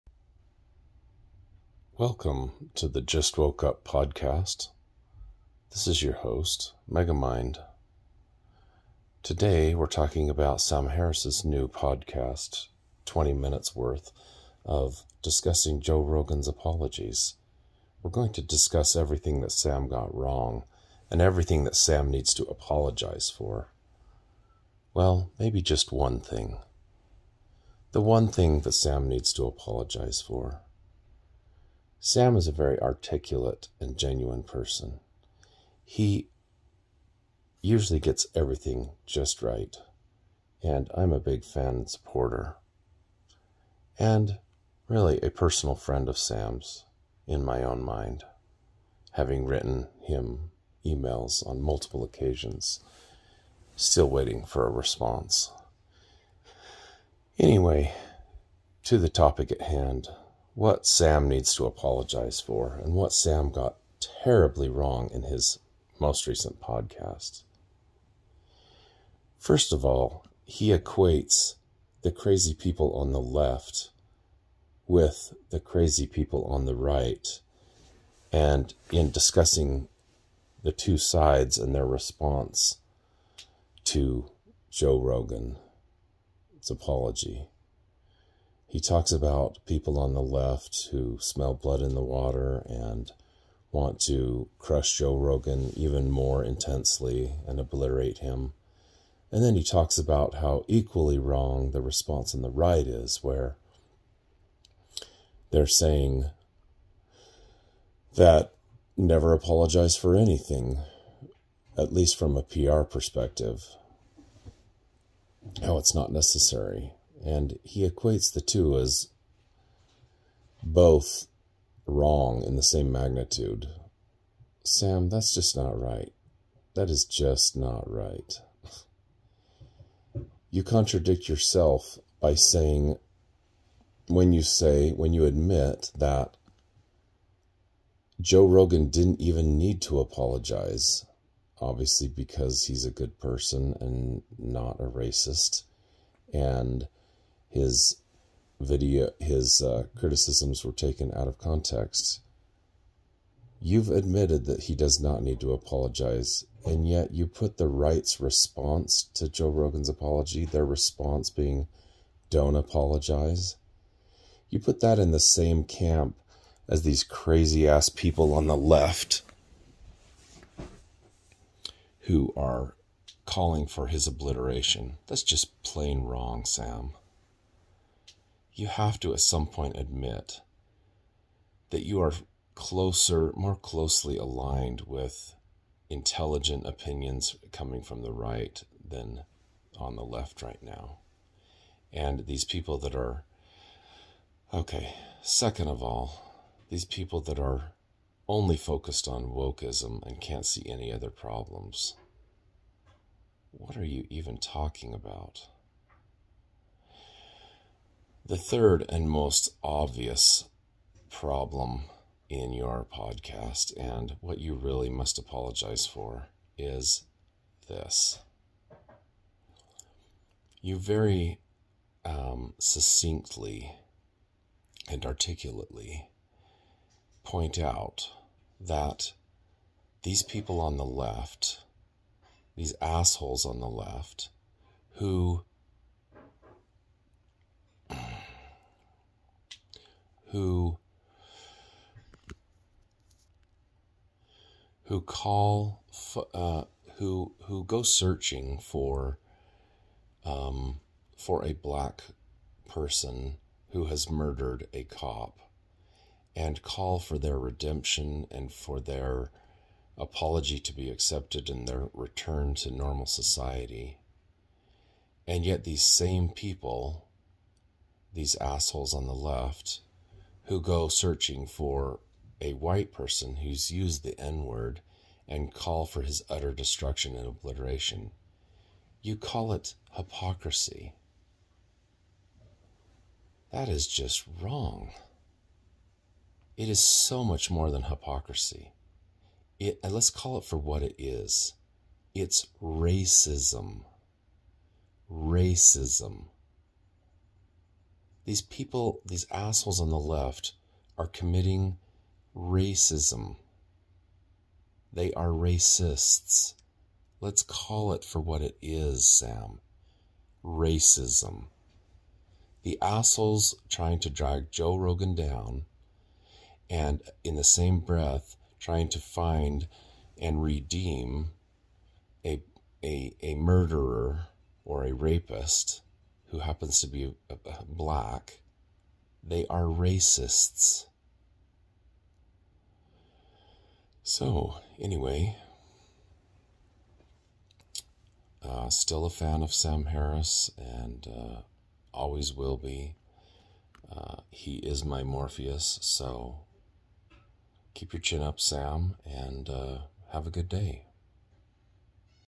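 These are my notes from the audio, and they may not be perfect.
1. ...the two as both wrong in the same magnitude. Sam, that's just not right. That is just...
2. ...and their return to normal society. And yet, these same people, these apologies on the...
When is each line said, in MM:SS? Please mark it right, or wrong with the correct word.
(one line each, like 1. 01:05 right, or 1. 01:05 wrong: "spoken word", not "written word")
1. 01:58 right
2. 04:21 wrong: "assholes", not "apologies".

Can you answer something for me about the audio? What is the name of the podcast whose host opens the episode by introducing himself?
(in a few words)
Just Woke Up.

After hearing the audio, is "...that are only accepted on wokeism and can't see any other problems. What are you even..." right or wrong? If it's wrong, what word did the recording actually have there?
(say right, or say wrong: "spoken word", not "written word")
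wrong: "focused", not "accepted".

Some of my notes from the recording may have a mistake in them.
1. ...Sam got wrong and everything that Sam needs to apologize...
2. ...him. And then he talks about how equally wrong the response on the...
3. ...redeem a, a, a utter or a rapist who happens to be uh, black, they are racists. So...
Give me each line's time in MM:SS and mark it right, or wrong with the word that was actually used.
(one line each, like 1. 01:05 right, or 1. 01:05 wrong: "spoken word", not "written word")
1. 00:19 right
2. 01:38 right
3. 05:20 wrong: "murderer", not "utter".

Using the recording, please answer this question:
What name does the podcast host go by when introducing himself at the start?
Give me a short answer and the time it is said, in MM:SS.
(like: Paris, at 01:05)
Megamind, at 00:06.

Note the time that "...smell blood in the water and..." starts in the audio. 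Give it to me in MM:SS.
01:31.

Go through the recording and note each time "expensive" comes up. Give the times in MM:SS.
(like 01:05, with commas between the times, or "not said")
not said.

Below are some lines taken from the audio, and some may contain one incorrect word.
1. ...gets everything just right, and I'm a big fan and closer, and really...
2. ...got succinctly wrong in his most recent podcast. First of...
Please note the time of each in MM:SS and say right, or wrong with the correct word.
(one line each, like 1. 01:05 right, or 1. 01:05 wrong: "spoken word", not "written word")
1. 00:37 wrong: "supporter", not "closer"
2. 01:03 wrong: "terribly", not "succinctly".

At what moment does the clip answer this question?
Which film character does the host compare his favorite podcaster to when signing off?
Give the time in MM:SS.
05:45.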